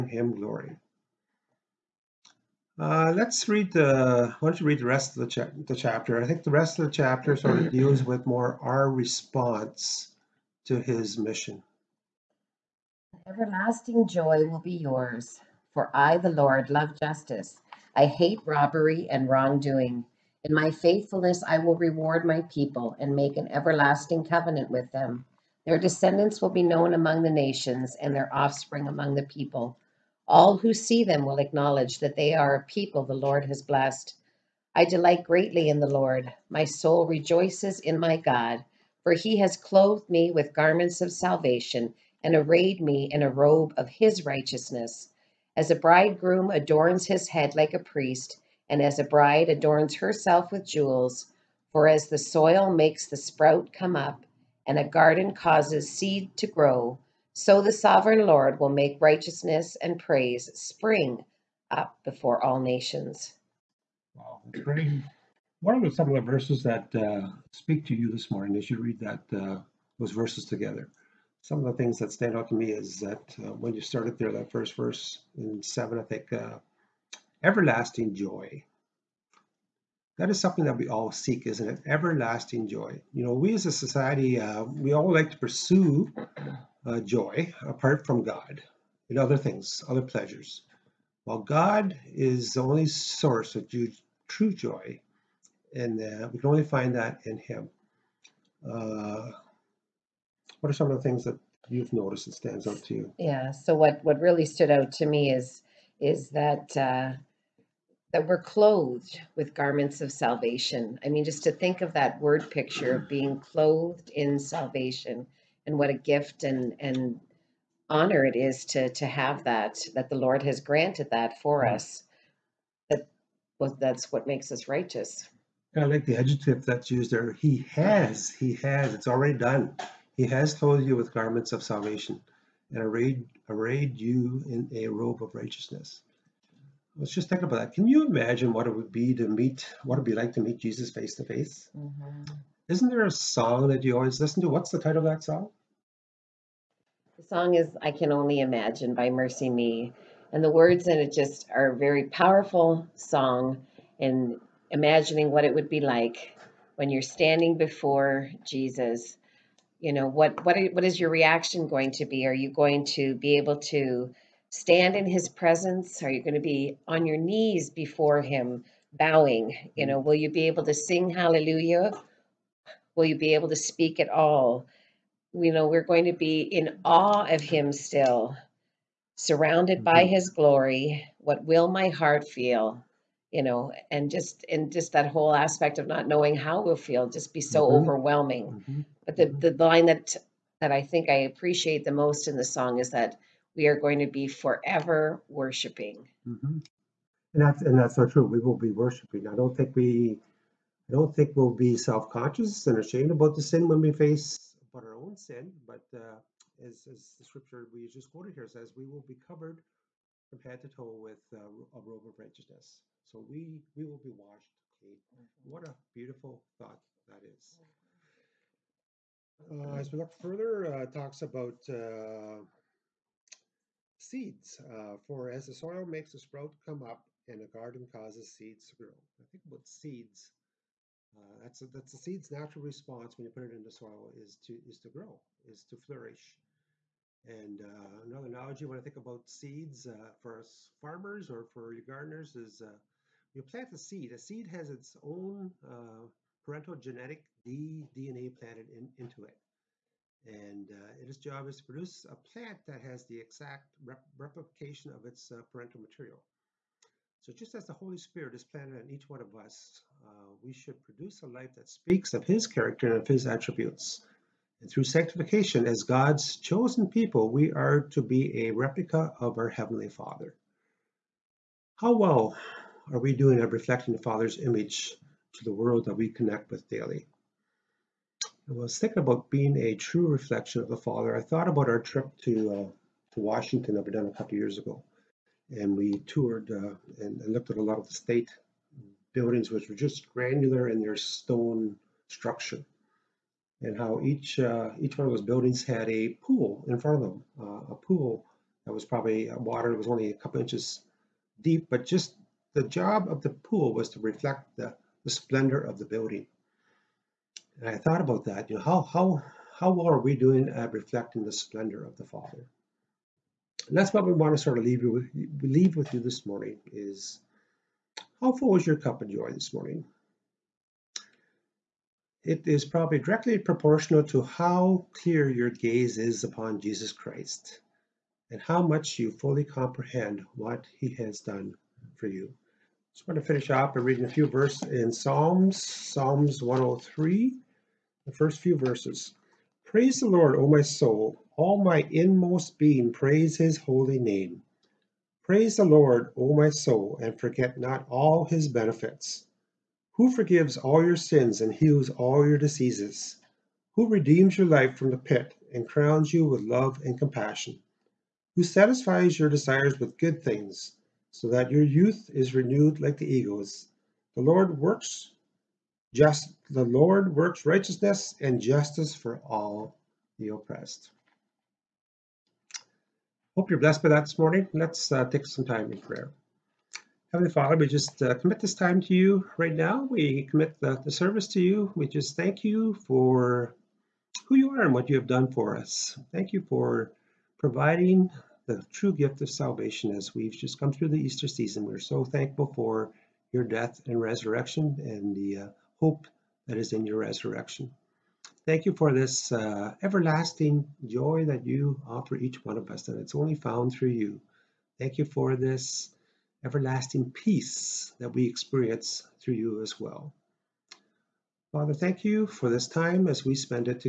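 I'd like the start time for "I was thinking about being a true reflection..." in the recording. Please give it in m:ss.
4:38.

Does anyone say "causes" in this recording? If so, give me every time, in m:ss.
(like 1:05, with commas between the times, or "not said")
0:55, 3:47.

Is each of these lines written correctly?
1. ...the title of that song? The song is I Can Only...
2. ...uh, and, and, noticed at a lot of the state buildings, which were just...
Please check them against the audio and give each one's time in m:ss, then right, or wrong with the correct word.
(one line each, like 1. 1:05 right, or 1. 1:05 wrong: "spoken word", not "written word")
1. 2:24 right
2. 4:46 wrong: "looked", not "noticed".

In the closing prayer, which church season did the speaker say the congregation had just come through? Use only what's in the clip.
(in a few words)
Easter.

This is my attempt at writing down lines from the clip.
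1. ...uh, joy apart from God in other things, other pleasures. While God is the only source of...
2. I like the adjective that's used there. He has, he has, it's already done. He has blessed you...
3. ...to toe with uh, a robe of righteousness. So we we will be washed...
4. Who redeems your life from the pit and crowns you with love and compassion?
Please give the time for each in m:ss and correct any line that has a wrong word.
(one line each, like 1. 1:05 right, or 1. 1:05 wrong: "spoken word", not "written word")
1. 1:26 right
2. 2:05 wrong: "clothed", not "blessed"
3. 3:30 right
4. 5:53 right.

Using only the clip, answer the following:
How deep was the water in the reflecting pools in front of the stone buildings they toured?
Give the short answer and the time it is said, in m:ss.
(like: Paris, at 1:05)
a couple inches, at 5:00.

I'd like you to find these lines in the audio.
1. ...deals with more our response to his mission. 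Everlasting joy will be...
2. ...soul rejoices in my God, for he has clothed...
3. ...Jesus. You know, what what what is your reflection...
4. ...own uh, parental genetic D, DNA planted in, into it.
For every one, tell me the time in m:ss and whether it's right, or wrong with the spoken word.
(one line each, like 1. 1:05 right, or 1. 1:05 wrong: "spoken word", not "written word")
1. 0:07 right
2. 0:36 right
3. 2:38 wrong: "reaction", not "reflection"
4. 4:05 right.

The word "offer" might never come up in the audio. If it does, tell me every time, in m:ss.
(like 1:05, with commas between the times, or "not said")
6:41.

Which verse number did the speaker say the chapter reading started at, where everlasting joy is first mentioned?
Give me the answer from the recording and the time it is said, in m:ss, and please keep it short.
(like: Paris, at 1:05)
7, at 1:15.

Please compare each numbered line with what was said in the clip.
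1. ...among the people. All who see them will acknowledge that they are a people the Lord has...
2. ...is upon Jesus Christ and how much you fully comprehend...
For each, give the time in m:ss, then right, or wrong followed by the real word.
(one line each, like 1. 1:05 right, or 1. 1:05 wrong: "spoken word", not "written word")
1. 0:28 right
2. 5:25 right.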